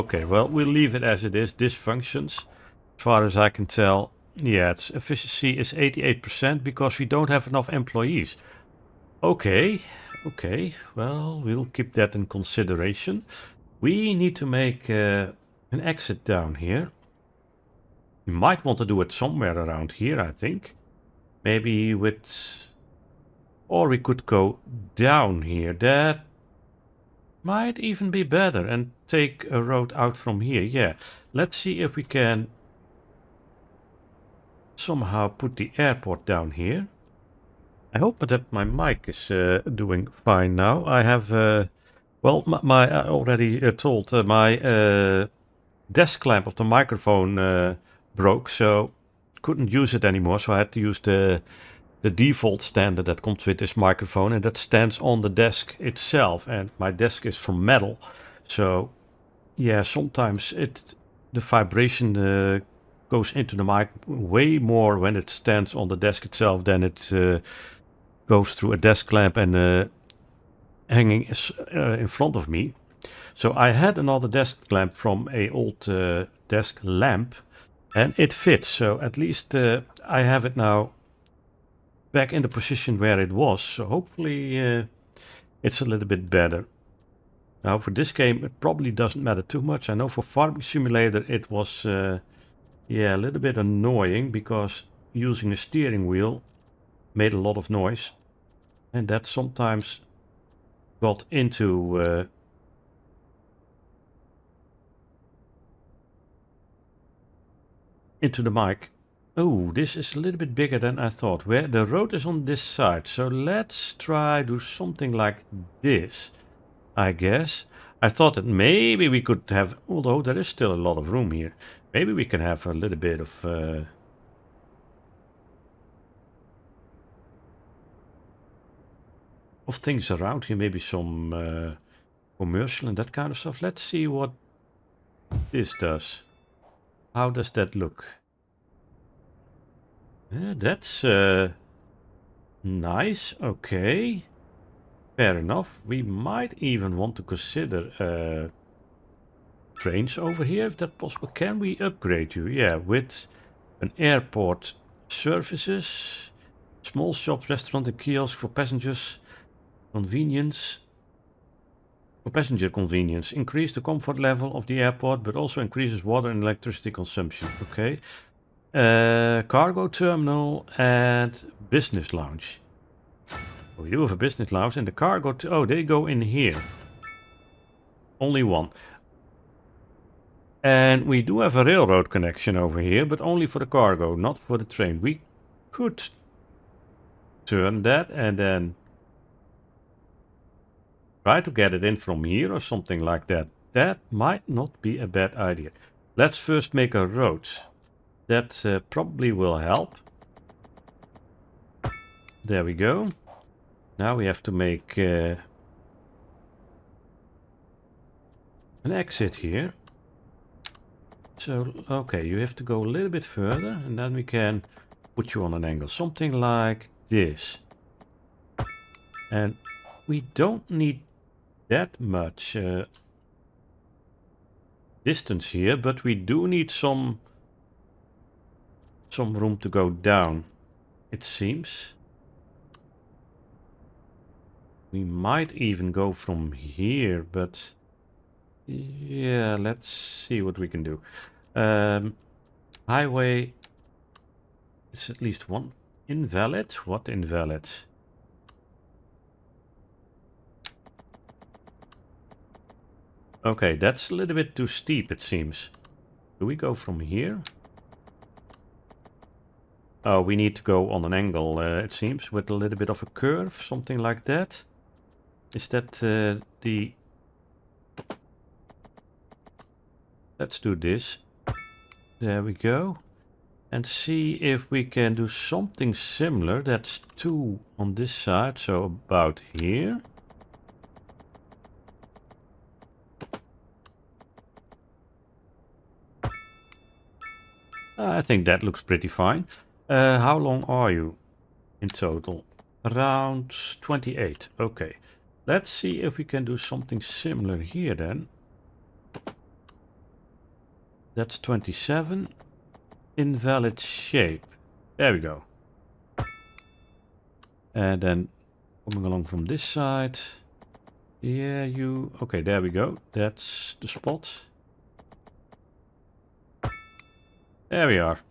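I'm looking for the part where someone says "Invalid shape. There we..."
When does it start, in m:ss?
5:03.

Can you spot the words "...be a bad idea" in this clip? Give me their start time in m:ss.
3:14.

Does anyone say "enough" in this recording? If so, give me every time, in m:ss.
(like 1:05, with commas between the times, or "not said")
0:07, 2:25.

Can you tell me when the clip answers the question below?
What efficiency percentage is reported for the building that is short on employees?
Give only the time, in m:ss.
0:05.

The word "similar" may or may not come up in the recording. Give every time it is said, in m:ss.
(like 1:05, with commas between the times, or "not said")
4:35, 4:57.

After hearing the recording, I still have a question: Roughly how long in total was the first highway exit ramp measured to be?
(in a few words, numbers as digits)
28.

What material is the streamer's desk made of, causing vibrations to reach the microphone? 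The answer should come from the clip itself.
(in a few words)
metal.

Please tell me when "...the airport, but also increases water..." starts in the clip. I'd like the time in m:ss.
2:44.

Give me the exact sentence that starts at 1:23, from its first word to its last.
So hopefully uh, it's a little bit better.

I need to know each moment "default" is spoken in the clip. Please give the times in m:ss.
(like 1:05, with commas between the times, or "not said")
0:52.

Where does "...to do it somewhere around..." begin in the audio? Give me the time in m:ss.
0:18.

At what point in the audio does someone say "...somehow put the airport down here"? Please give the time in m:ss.
0:34.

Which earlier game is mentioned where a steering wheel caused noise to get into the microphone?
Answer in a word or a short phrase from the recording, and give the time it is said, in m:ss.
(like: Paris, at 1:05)
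Farming Simulator, at 1:30.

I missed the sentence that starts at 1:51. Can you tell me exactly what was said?
Where the road is on this side.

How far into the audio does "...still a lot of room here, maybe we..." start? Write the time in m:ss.
2:00.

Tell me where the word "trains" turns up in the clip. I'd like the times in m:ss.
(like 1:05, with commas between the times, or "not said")
2:29, 3:04.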